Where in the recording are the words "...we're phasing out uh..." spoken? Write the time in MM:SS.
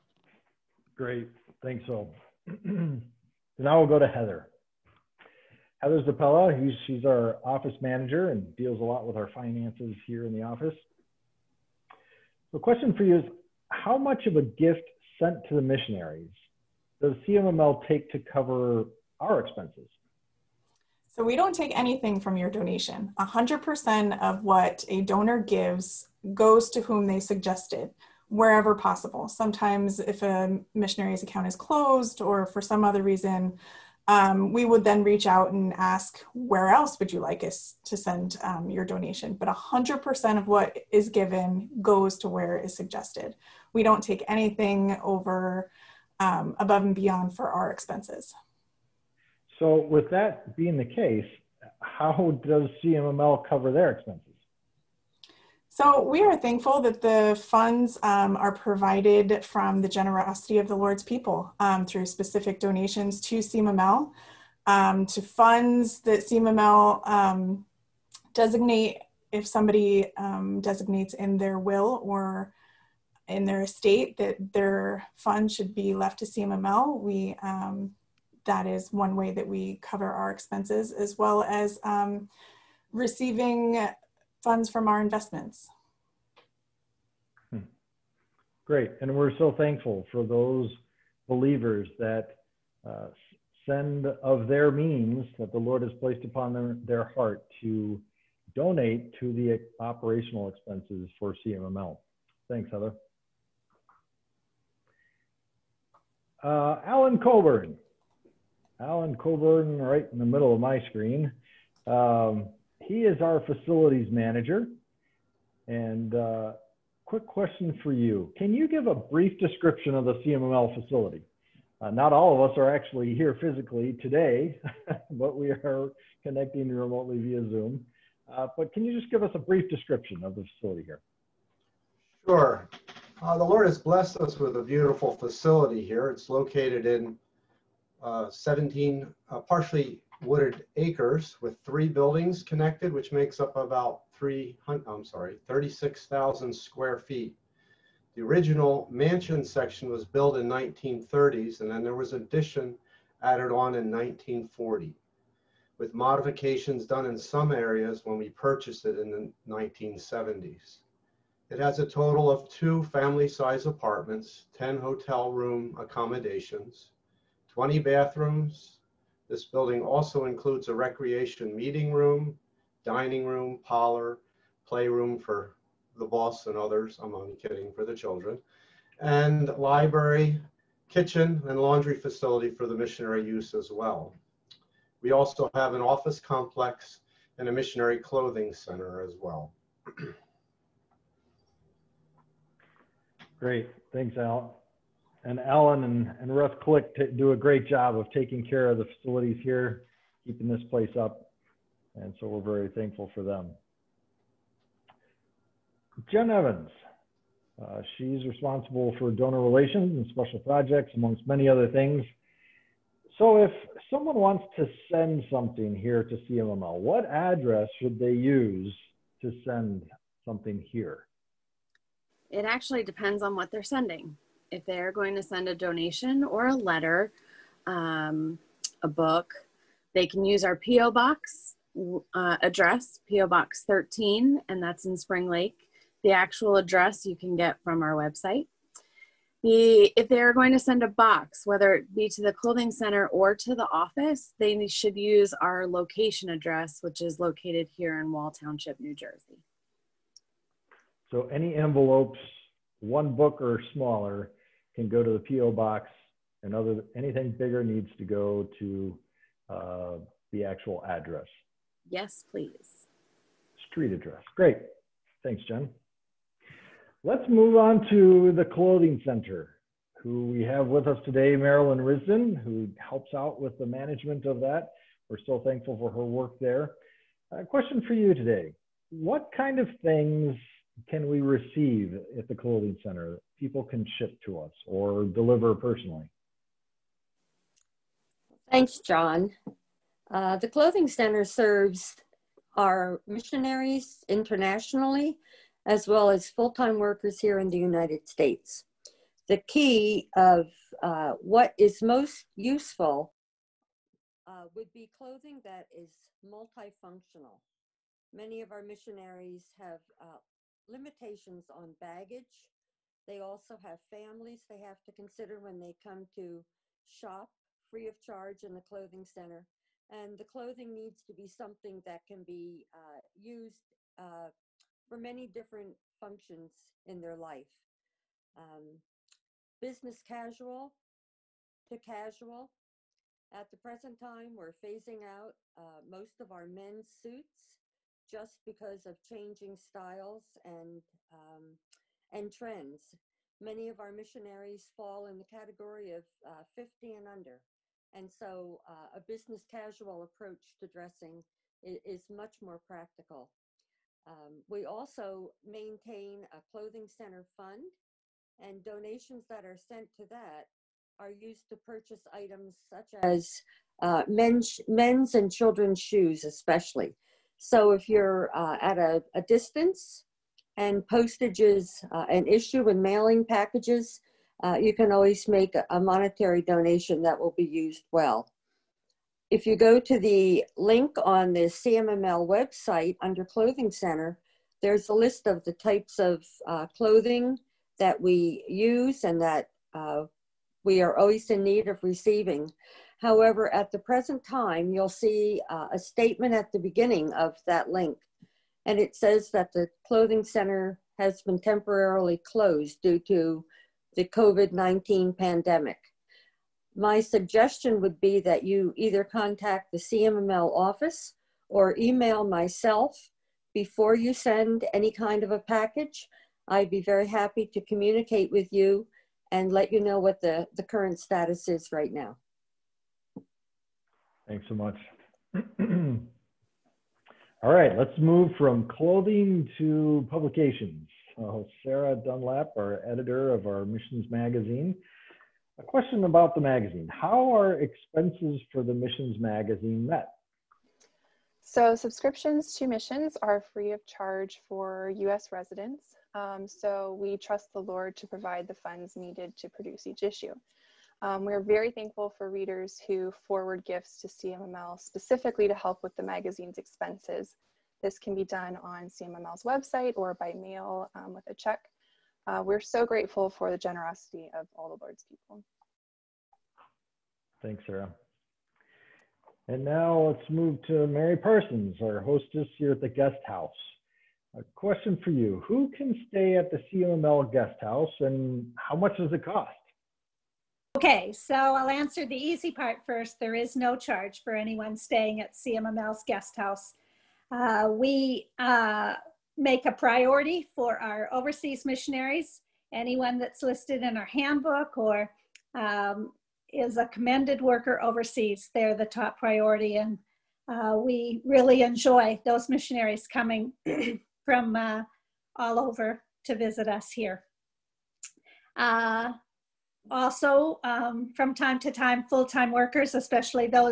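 05:34.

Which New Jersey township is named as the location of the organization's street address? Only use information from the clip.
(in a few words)
Wall Township.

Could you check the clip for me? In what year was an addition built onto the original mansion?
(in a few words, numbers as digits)
1940.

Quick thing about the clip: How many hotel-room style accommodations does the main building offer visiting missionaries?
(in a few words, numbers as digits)
10.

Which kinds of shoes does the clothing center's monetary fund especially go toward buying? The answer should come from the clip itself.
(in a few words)
men's and children's shoes.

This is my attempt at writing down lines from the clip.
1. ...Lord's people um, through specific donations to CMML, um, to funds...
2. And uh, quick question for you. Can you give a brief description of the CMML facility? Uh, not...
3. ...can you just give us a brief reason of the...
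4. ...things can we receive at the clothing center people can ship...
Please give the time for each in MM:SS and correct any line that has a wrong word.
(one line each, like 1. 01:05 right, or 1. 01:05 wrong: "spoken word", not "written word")
1. 01:00 right
2. 01:55 right
3. 02:08 wrong: "description", not "reason"
4. 04:39 right.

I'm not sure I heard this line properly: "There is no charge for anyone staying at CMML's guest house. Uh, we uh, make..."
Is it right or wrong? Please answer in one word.
right.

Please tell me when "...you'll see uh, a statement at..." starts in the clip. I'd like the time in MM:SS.
06:34.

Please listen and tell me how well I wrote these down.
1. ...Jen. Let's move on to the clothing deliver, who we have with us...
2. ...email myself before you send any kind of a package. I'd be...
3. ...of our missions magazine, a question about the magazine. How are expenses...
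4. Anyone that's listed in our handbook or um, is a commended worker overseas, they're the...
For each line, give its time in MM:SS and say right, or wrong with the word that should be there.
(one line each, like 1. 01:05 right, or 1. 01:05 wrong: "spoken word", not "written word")
1. 04:25 wrong: "center", not "deliver"
2. 06:51 right
3. 07:13 right
4. 08:12 right.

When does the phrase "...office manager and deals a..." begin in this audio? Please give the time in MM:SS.
00:07.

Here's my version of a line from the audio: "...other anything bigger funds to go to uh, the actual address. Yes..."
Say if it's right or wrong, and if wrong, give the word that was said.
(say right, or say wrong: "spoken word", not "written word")
wrong: "needs", not "funds".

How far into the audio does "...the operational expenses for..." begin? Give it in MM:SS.
01:39.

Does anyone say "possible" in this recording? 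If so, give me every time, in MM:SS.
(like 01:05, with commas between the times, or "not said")
00:28.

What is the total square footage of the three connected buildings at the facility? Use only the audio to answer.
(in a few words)
36,000.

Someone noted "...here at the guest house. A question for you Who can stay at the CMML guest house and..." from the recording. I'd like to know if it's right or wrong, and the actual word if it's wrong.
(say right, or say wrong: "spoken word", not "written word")
right.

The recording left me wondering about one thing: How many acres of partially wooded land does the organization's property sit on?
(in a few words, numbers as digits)
17.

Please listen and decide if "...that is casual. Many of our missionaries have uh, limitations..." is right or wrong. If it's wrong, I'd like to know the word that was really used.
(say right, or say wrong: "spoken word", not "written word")
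wrong: "multifunctional", not "casual".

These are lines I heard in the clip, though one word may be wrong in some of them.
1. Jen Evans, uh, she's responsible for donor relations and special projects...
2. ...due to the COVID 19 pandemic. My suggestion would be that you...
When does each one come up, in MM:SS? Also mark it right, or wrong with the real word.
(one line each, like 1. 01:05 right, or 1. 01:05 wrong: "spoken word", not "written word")
1. 03:26 right
2. 06:42 right.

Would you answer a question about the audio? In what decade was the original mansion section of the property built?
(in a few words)
1930s.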